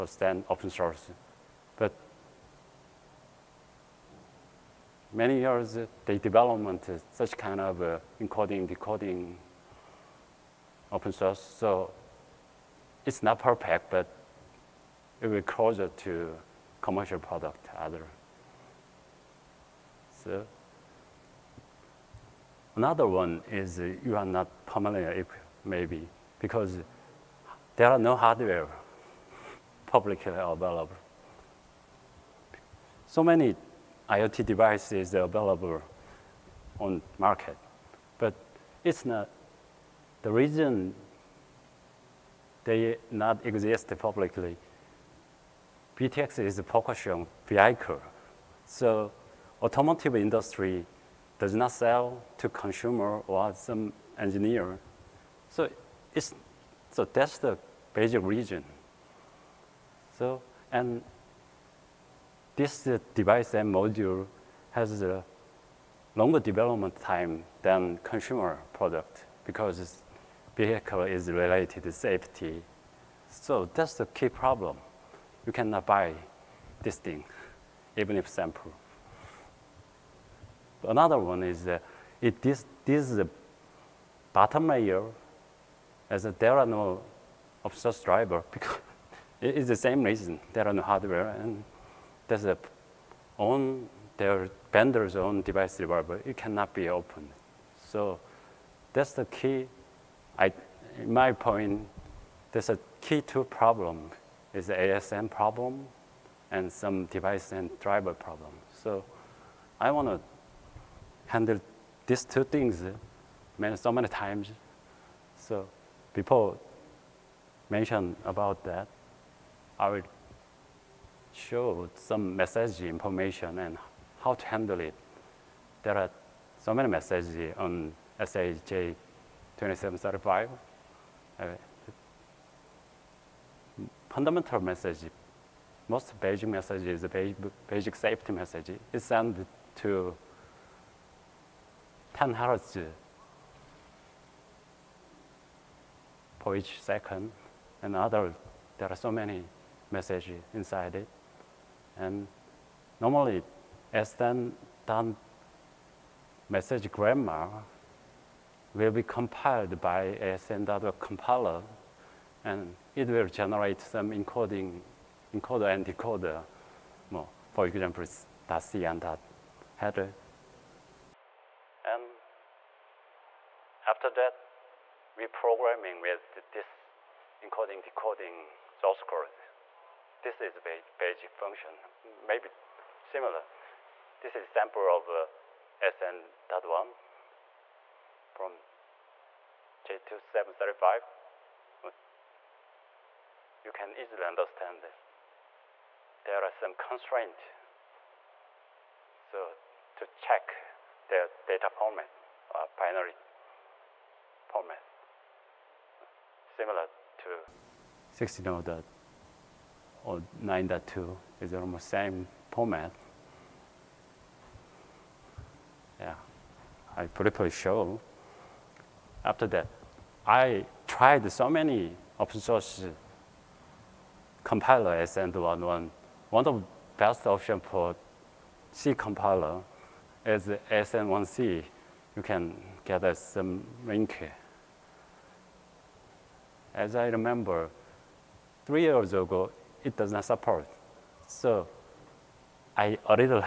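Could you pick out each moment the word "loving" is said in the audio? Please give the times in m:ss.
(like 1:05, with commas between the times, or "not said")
not said.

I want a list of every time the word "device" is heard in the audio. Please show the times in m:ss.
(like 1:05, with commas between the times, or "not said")
0:34, 1:03, 1:35, 1:47.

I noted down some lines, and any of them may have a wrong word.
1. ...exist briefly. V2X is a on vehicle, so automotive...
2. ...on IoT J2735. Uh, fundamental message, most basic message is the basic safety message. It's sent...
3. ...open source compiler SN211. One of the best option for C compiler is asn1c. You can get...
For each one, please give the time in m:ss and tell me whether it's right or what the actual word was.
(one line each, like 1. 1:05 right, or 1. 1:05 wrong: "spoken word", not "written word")
1. 0:43 wrong: "publicly", not "briefly"
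2. 2:07 wrong: "SAE", not "IoT"
3. 3:42 right.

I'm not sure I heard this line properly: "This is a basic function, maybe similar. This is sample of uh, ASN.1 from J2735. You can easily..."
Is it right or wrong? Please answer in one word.
right.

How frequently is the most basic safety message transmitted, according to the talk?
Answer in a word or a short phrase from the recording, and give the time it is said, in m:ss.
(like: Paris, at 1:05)
10 hertz, at 2:22.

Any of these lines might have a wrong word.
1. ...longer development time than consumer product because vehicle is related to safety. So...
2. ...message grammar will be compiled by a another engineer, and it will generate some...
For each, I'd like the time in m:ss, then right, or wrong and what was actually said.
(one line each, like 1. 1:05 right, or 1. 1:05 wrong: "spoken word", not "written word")
1. 1:06 right
2. 2:36 wrong: "compiler", not "engineer".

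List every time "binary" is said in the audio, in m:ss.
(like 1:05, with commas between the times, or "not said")
3:22.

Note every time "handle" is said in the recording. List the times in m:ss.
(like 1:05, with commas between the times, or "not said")
1:51, 2:04.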